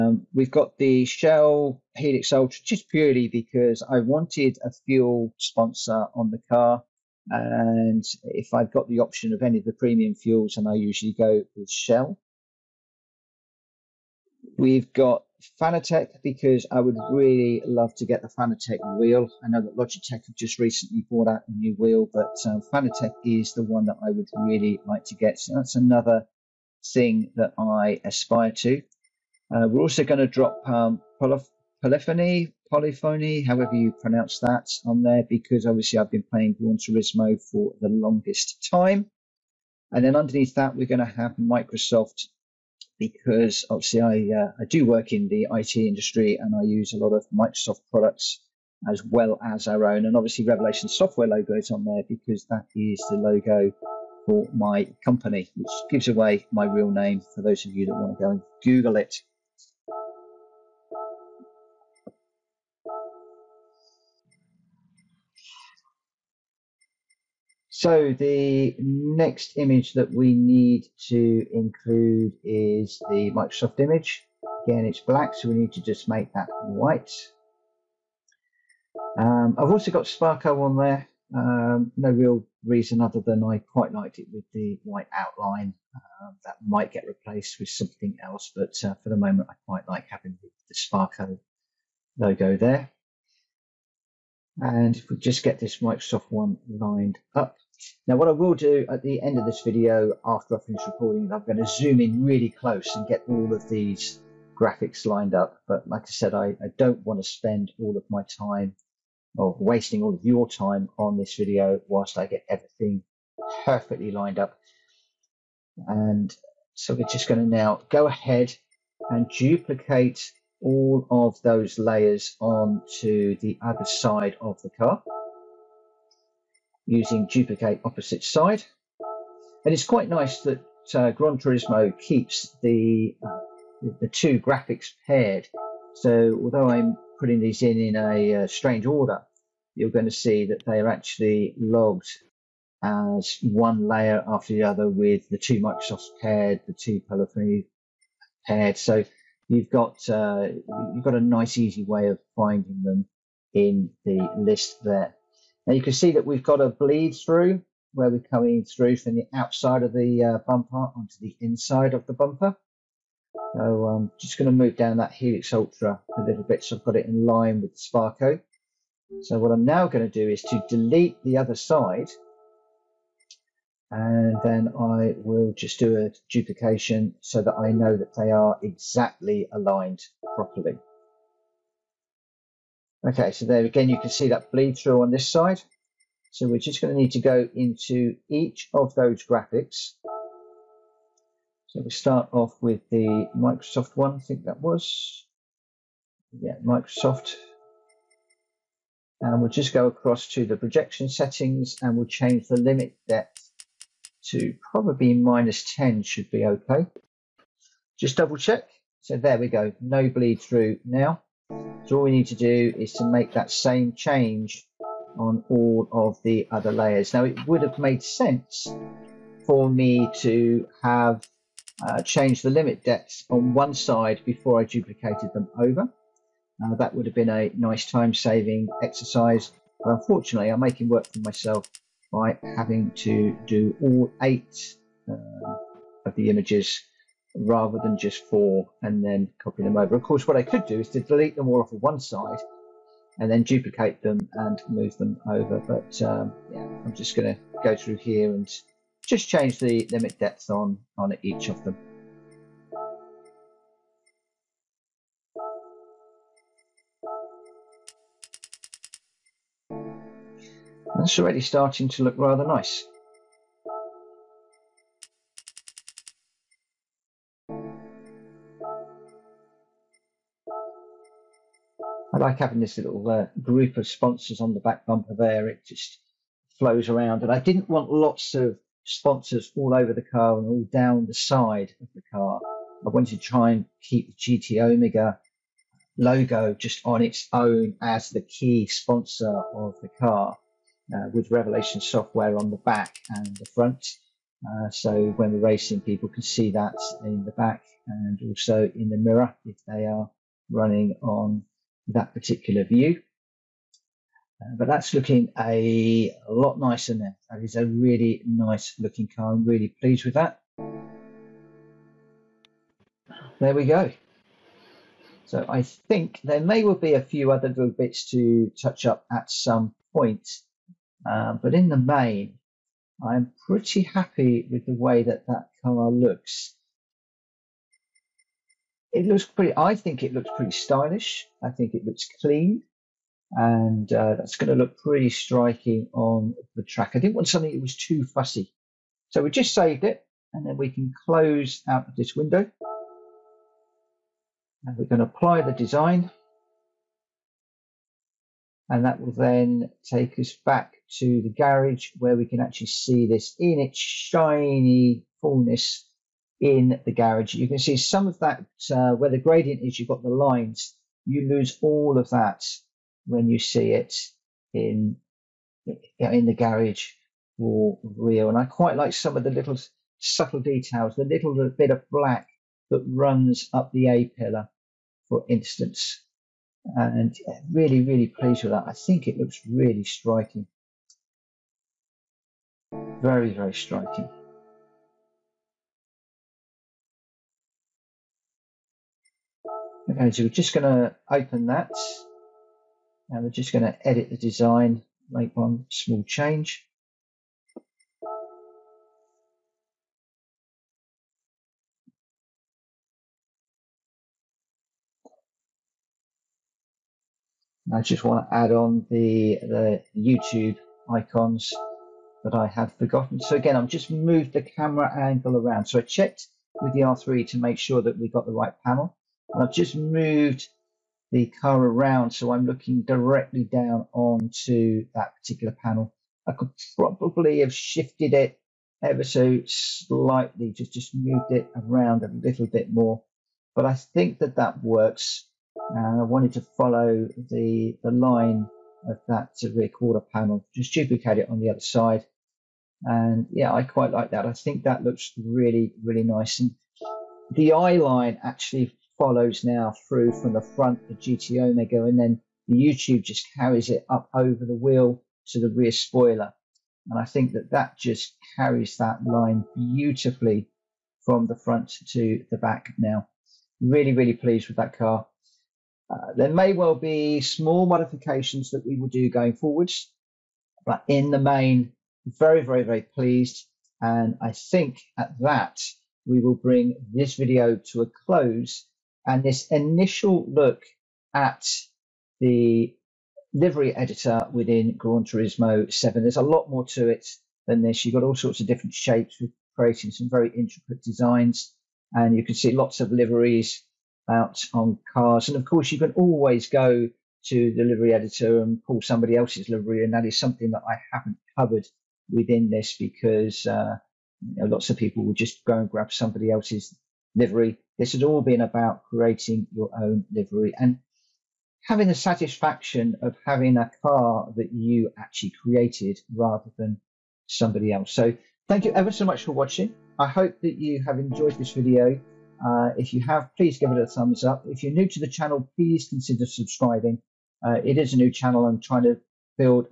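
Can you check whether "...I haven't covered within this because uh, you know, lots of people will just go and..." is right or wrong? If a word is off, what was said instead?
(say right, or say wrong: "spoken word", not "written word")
right.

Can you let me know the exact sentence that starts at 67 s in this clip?
So the next image that we need to include is the Microsoft image.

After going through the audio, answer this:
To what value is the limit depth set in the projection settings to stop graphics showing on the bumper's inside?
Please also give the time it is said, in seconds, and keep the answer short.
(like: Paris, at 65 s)
-10, at 205 s.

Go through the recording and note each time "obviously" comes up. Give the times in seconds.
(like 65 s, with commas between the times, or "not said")
35 s, 43 s, 50 s.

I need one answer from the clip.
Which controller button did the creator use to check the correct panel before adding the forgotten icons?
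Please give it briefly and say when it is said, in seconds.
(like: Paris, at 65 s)
R3, at 416 s.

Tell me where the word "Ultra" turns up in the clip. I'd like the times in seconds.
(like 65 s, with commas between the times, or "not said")
2 s, 165 s.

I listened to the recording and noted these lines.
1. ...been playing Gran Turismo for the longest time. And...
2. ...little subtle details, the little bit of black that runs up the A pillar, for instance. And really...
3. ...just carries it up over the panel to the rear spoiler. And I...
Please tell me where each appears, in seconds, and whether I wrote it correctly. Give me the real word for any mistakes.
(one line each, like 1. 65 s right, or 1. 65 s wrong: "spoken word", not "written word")
1. 36 s right
2. 369 s right
3. 453 s wrong: "wheel", not "panel".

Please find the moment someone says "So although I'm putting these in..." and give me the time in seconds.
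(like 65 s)
135 s.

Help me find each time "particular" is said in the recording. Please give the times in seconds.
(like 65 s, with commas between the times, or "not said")
302 s, 425 s.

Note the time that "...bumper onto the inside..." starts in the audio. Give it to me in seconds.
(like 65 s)
160 s.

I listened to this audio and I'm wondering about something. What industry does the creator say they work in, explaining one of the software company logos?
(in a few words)
IT industry.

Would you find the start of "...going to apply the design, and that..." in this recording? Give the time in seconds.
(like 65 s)
344 s.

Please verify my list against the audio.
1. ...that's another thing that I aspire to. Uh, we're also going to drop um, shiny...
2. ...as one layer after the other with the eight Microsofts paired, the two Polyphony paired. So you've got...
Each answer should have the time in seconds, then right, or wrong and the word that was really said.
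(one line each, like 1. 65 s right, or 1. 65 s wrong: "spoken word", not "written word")
1. 25 s wrong: "polyphony", not "shiny"
2. 142 s wrong: "two", not "eight".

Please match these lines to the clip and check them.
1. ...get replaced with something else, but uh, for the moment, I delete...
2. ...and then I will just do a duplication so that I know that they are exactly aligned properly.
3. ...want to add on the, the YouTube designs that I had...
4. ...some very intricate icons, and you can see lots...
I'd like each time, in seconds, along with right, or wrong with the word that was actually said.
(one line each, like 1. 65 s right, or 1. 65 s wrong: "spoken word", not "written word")
1. 86 s wrong: "quite", not "delete"
2. 173 s right
3. 408 s wrong: "icons", not "designs"
4. 489 s wrong: "designs", not "icons".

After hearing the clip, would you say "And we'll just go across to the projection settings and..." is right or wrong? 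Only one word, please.
right.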